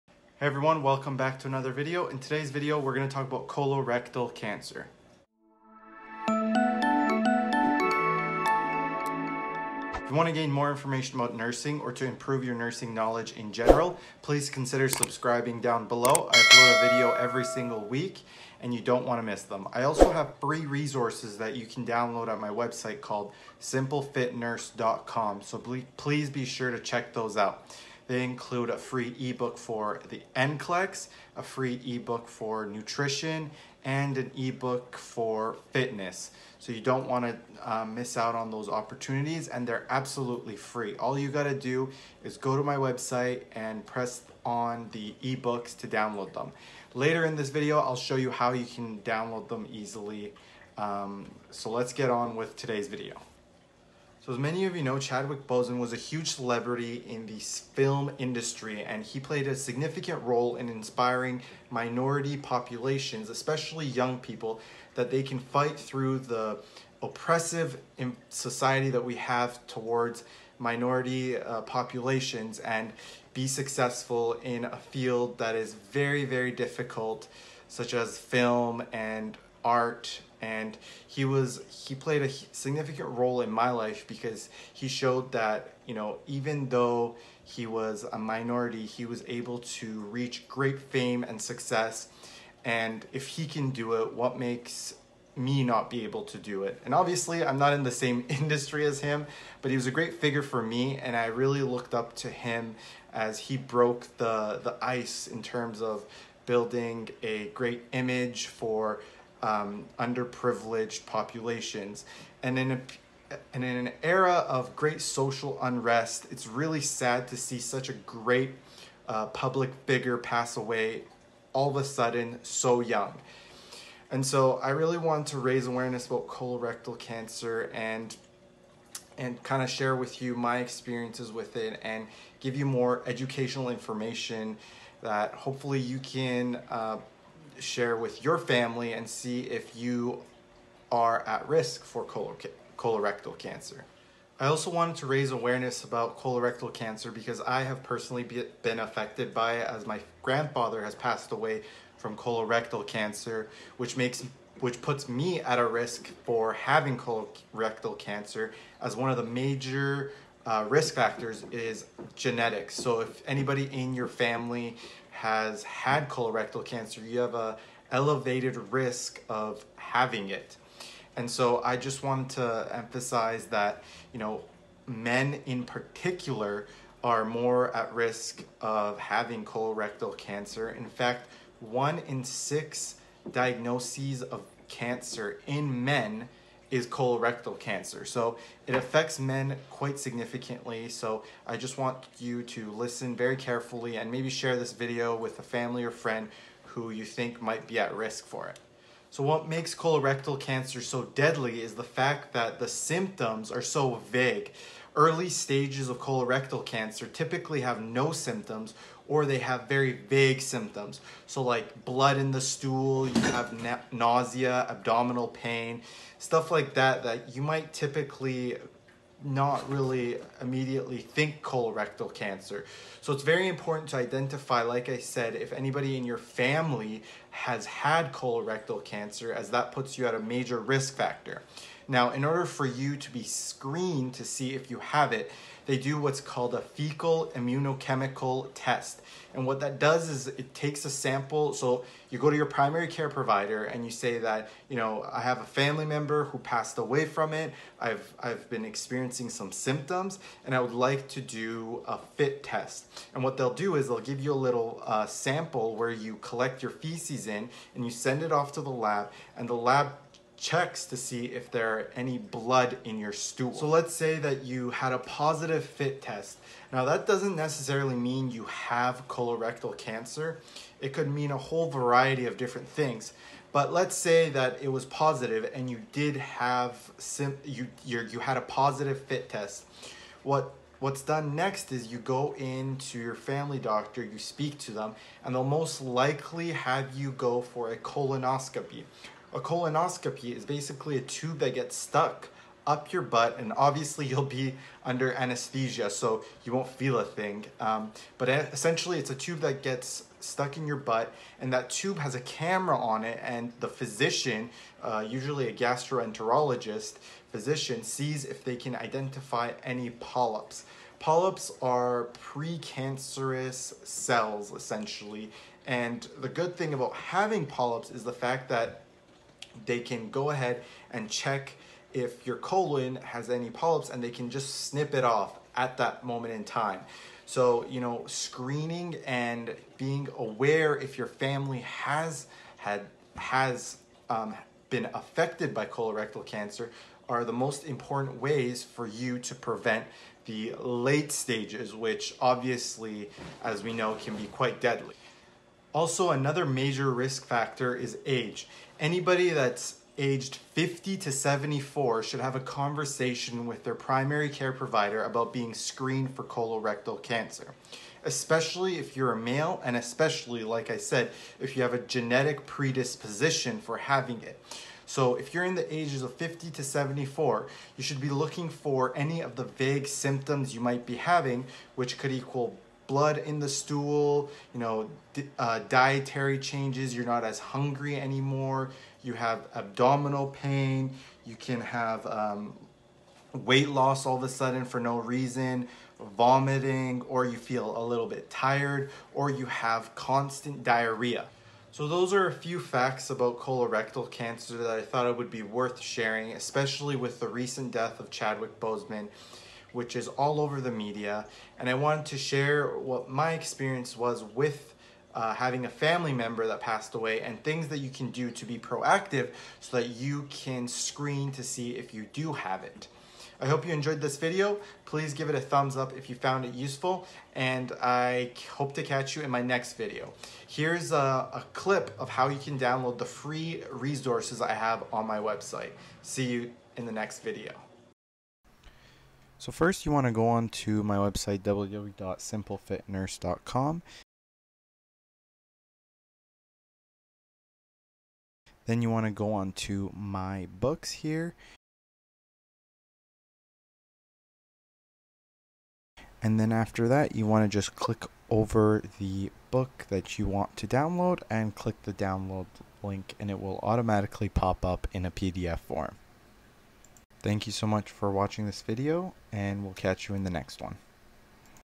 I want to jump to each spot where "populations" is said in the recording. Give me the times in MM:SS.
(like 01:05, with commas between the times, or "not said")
01:02, 01:11, 01:51.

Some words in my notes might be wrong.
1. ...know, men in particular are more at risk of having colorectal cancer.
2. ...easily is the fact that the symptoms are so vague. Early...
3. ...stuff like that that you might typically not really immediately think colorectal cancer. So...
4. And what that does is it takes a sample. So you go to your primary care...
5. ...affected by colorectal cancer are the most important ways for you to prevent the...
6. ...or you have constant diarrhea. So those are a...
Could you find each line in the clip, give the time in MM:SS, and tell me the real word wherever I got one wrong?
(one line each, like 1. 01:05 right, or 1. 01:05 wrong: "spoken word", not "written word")
1. 02:54 right
2. 03:21 wrong: "deadly", not "easily"
3. 03:36 right
4. 03:59 right
5. 05:34 right
6. 06:29 right.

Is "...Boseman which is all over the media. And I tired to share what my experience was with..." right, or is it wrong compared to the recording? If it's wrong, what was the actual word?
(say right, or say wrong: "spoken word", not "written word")
wrong: "wanted", not "tired".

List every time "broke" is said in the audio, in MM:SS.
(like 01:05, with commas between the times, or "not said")
01:43.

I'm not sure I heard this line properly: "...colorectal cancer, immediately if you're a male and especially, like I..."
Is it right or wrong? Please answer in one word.
wrong.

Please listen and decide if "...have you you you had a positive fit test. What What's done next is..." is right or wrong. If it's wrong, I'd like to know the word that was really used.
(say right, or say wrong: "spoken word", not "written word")
right.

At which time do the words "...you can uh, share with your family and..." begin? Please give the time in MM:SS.
02:15.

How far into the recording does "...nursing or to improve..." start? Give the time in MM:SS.
00:11.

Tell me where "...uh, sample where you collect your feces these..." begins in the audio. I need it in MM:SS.
04:14.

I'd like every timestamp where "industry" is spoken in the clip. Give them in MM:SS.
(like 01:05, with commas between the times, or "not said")
00:58, 01:38.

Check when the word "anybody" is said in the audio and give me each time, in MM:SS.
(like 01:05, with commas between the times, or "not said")
02:43, 03:45, 05:48.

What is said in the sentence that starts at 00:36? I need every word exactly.
So you don't want to uh, miss out on those opportunities, and they're absolutely free.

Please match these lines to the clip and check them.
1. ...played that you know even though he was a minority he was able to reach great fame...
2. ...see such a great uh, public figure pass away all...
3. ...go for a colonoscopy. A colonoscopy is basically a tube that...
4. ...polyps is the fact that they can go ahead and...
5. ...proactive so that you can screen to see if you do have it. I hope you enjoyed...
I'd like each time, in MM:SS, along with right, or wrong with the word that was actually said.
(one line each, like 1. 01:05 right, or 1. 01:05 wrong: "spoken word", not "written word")
1. 01:24 wrong: "showed", not "played"
2. 01:57 right
3. 04:47 right
4. 05:17 right
5. 06:48 right.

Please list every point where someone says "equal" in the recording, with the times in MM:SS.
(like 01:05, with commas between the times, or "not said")
06:12.